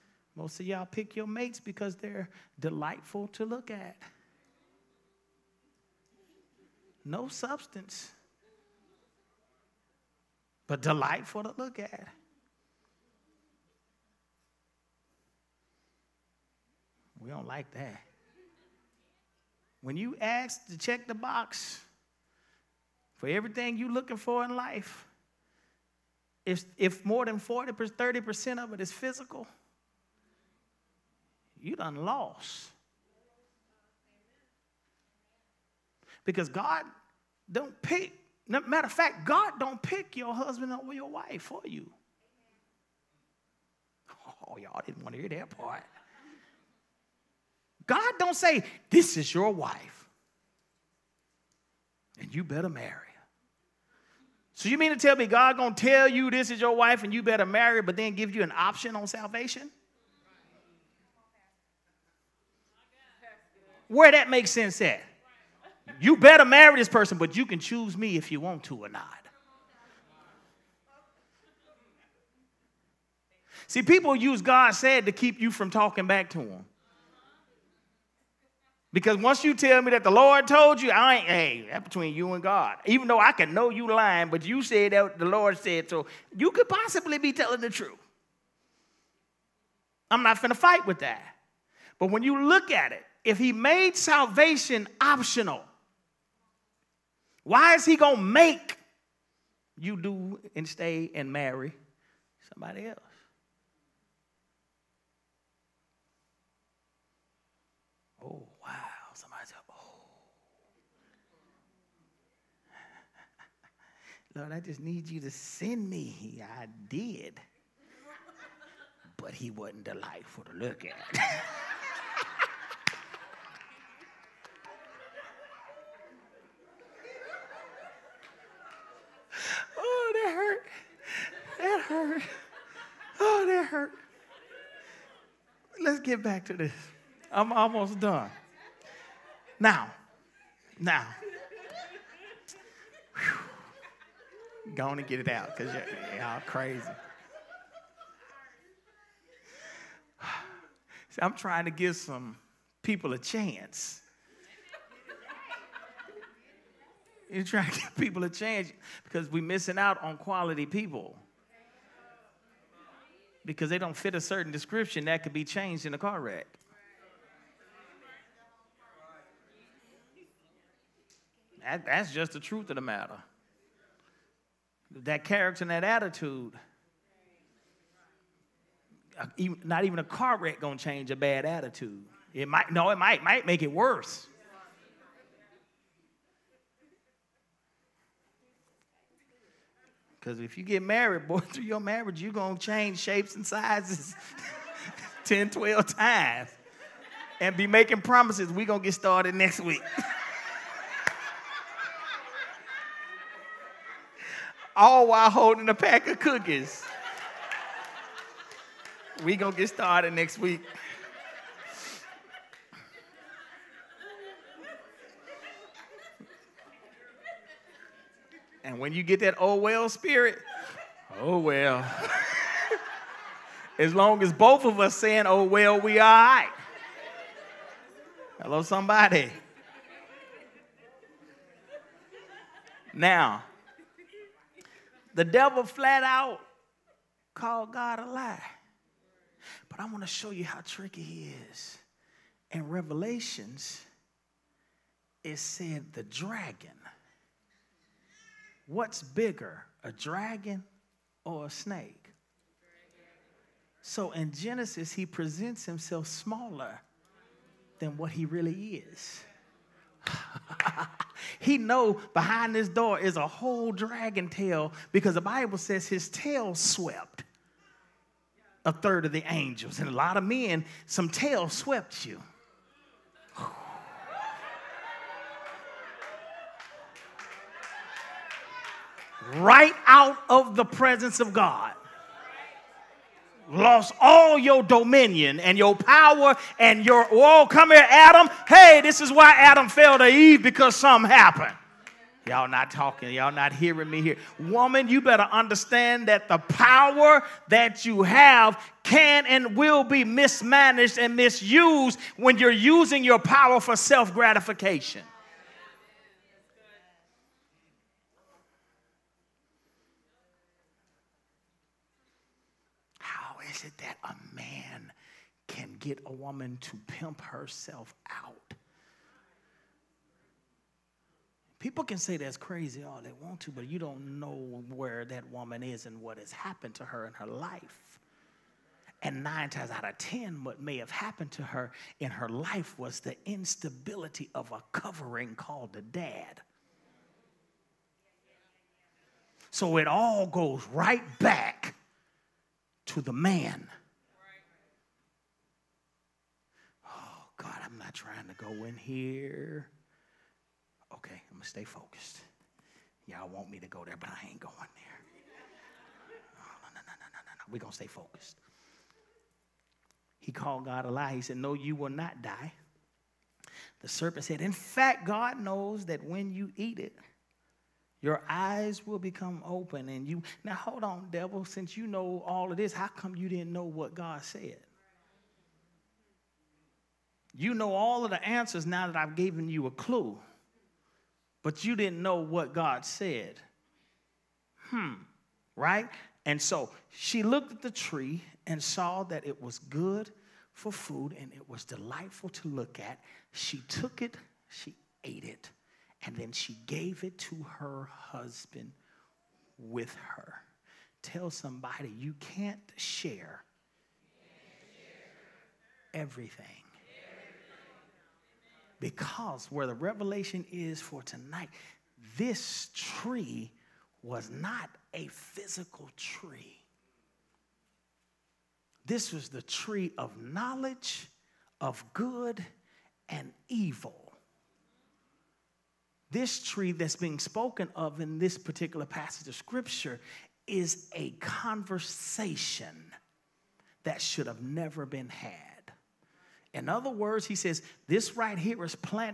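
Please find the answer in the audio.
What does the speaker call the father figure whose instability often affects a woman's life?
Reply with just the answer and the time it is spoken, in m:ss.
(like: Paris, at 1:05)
a covering, at 5:34.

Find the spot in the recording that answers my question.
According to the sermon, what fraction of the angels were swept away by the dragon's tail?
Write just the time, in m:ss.
4:28.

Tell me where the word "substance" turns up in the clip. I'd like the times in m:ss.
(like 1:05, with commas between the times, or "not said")
0:07.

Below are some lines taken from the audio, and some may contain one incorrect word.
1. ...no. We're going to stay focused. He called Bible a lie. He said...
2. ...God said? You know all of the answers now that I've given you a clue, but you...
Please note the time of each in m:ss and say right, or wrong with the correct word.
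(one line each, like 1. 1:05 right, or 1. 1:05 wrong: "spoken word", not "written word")
1. 5:57 wrong: "God", not "Bible"
2. 6:13 right.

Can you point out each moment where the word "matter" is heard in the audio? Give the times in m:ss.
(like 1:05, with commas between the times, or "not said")
0:38, 2:52.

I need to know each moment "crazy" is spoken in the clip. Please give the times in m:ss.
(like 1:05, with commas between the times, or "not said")
2:26, 5:22.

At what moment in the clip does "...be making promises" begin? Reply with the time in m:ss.
3:17.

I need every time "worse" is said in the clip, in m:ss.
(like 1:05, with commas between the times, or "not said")
3:03.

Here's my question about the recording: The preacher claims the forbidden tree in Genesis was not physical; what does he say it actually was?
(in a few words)
a conversation.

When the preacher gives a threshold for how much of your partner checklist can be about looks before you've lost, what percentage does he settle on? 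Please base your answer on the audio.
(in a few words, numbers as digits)
30%.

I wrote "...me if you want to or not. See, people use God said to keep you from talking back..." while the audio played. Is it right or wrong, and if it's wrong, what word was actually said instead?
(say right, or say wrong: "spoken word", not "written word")
right.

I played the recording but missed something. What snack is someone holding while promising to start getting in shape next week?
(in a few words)
cookies.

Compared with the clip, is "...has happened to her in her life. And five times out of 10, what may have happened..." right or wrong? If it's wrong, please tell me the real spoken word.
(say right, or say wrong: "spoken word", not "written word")
wrong: "nine", not "five".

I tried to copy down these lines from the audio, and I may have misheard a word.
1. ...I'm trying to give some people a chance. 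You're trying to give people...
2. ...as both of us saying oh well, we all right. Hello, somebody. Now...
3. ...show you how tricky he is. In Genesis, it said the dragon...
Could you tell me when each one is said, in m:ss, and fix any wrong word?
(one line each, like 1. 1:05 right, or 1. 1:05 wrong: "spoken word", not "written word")
1. 2:31 right
2. 3:44 right
3. 4:00 wrong: "Revelations", not "Genesis".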